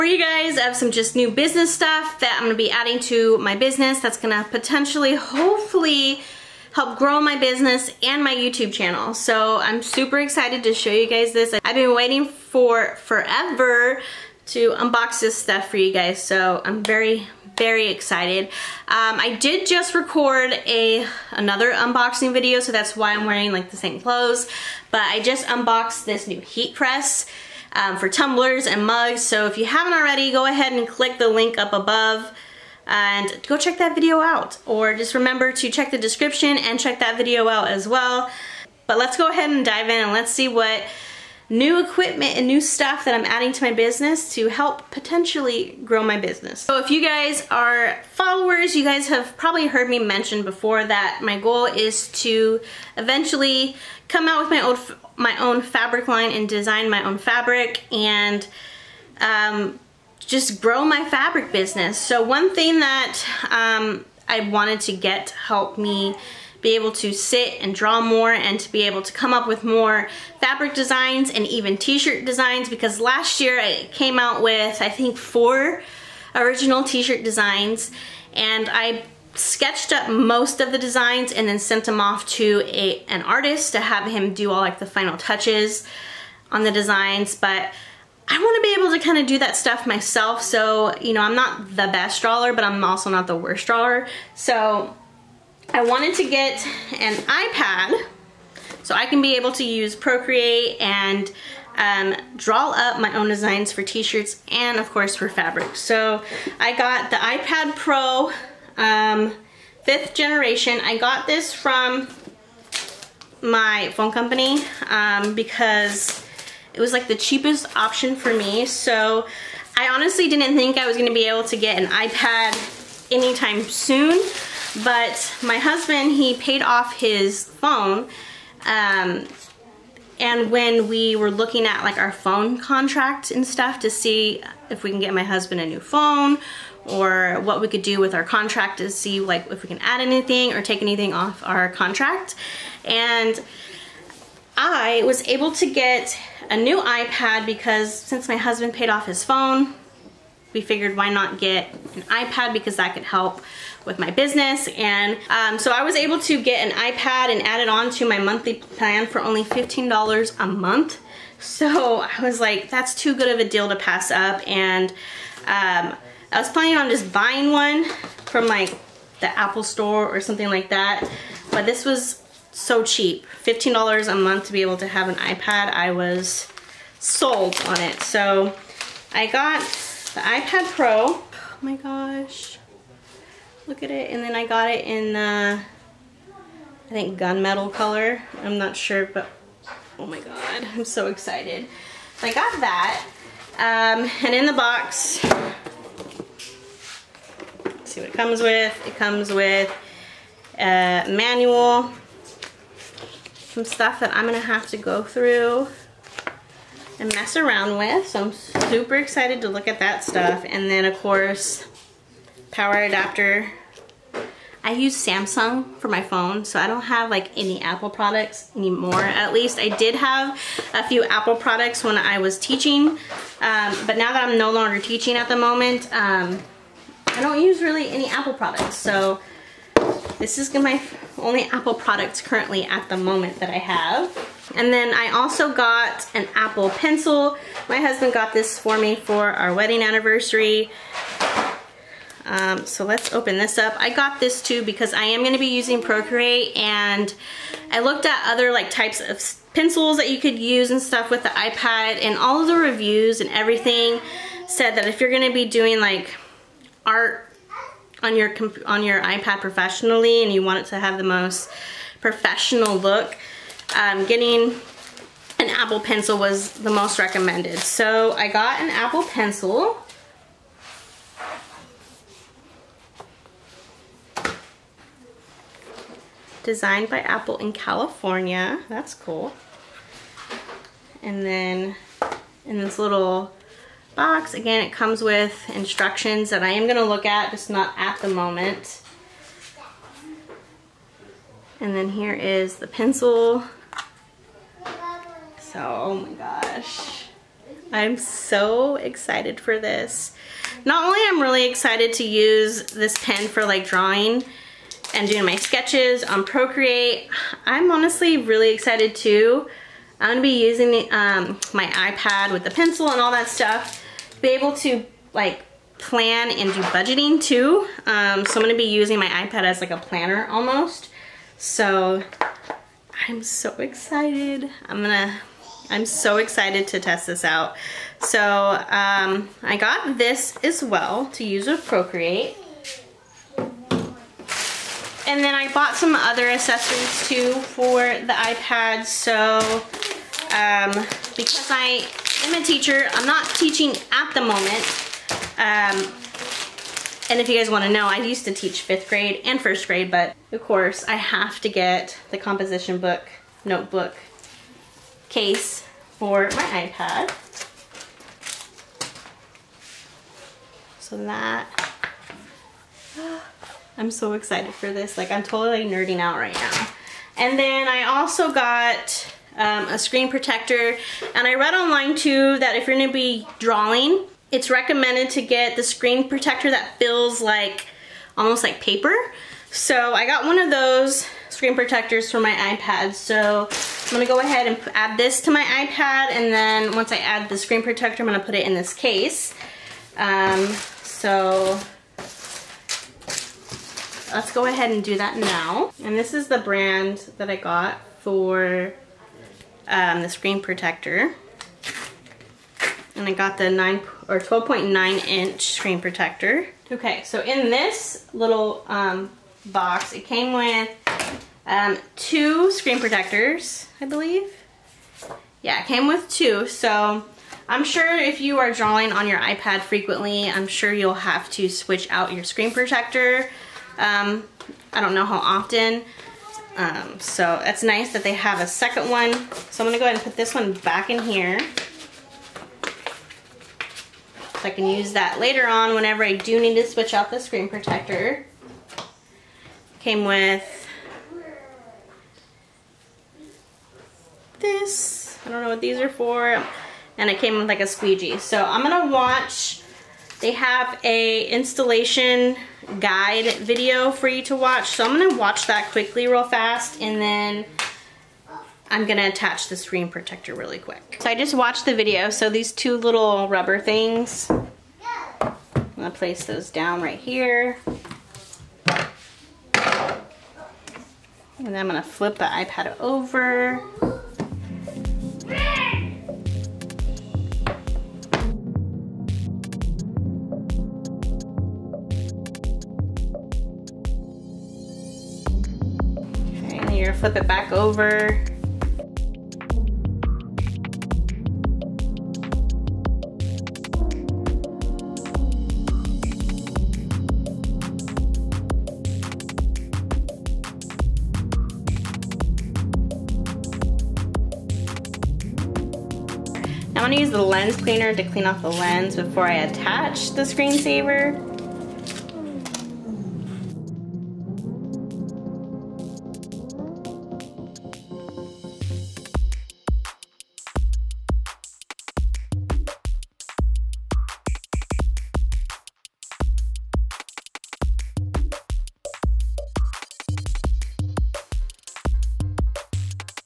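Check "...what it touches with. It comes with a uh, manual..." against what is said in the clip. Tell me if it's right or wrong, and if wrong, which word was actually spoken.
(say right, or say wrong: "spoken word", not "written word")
wrong: "comes", not "touches".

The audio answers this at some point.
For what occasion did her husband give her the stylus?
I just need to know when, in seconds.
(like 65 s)
239 s.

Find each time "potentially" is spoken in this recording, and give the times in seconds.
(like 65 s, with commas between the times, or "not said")
4 s, 44 s.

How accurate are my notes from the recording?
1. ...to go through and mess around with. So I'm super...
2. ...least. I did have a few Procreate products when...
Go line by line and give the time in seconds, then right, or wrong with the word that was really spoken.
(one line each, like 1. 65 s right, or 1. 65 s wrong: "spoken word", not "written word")
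1. 204 s right
2. 219 s wrong: "Apple", not "Procreate".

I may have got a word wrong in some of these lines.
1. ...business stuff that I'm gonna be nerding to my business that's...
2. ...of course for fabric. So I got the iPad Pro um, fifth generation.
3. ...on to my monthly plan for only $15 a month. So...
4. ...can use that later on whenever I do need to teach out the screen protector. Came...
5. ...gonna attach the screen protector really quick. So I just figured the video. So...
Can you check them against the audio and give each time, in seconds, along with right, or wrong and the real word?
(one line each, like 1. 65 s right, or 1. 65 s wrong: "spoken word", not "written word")
1. 1 s wrong: "adding", not "nerding"
2. 104 s right
3. 157 s right
4. 434 s wrong: "switch", not "teach"
5. 458 s wrong: "watched", not "figured".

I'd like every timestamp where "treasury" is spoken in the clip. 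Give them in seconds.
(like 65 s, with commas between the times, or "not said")
not said.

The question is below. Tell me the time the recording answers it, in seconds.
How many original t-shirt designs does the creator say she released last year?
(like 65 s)
75 s.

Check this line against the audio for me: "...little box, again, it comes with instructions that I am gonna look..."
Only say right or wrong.
right.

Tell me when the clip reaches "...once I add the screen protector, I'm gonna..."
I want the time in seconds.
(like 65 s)
386 s.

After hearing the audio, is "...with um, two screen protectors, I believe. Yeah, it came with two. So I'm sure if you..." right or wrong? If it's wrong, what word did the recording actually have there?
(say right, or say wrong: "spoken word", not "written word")
right.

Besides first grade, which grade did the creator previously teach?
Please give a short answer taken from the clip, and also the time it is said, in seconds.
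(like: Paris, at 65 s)
Fifth grade, at 348 s.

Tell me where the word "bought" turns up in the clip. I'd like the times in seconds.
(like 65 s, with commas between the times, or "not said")
335 s.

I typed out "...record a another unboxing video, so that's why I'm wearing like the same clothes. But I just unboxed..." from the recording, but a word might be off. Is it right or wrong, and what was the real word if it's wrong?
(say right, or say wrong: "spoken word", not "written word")
right.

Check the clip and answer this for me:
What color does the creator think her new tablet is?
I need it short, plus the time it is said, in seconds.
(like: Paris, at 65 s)
Gunmetal, at 187 s.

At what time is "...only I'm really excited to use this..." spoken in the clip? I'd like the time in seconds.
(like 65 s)
300 s.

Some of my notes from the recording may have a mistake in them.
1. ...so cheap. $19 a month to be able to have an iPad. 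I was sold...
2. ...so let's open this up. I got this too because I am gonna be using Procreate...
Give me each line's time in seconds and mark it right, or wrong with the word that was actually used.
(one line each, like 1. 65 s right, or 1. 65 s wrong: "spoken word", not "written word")
1. 172 s wrong: "15", not "19"
2. 242 s right.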